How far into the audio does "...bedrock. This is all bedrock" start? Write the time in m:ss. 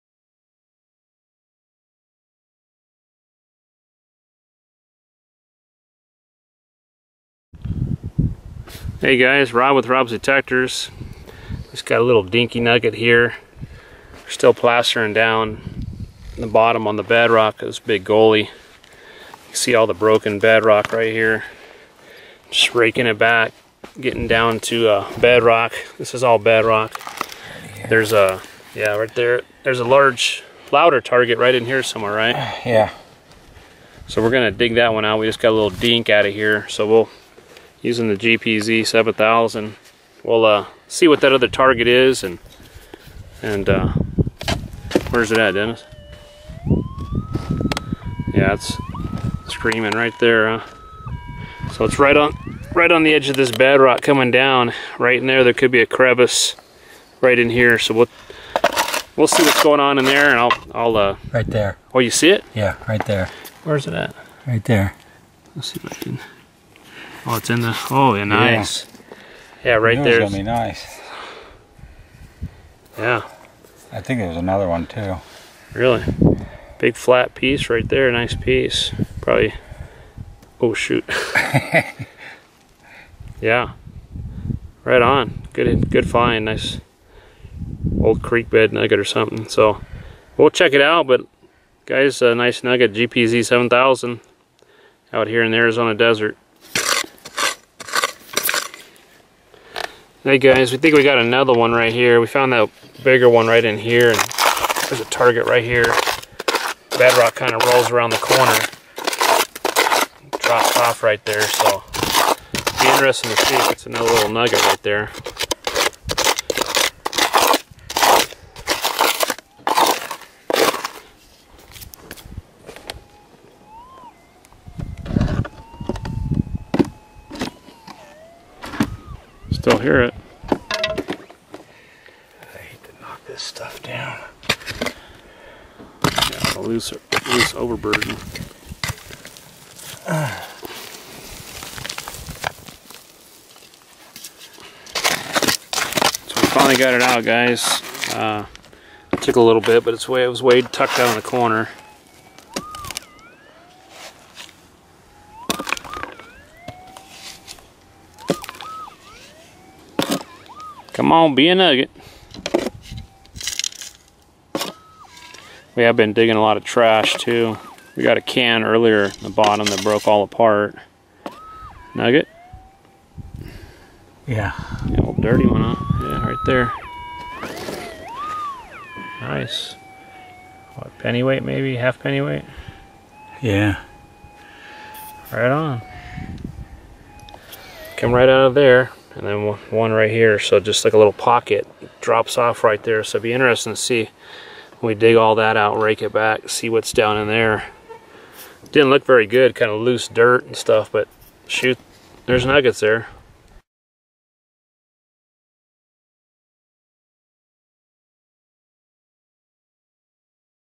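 0:25.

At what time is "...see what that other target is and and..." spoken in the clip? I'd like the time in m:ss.
0:40.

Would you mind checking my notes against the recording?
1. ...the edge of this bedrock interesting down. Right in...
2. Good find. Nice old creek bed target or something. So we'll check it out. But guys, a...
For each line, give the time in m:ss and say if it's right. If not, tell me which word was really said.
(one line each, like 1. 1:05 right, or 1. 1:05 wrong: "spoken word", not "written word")
1. 0:53 wrong: "coming", not "interesting"
2. 1:25 wrong: "nugget", not "target".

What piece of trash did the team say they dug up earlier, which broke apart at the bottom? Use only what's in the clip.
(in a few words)
A can.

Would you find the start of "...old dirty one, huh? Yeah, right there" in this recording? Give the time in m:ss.
2:55.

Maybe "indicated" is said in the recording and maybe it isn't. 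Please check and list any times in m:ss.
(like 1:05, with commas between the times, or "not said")
not said.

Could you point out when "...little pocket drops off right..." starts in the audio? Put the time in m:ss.
3:10.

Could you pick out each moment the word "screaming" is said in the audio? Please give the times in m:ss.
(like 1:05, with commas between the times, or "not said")
0:49.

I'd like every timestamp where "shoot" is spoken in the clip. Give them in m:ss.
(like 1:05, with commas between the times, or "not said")
1:20, 3:21.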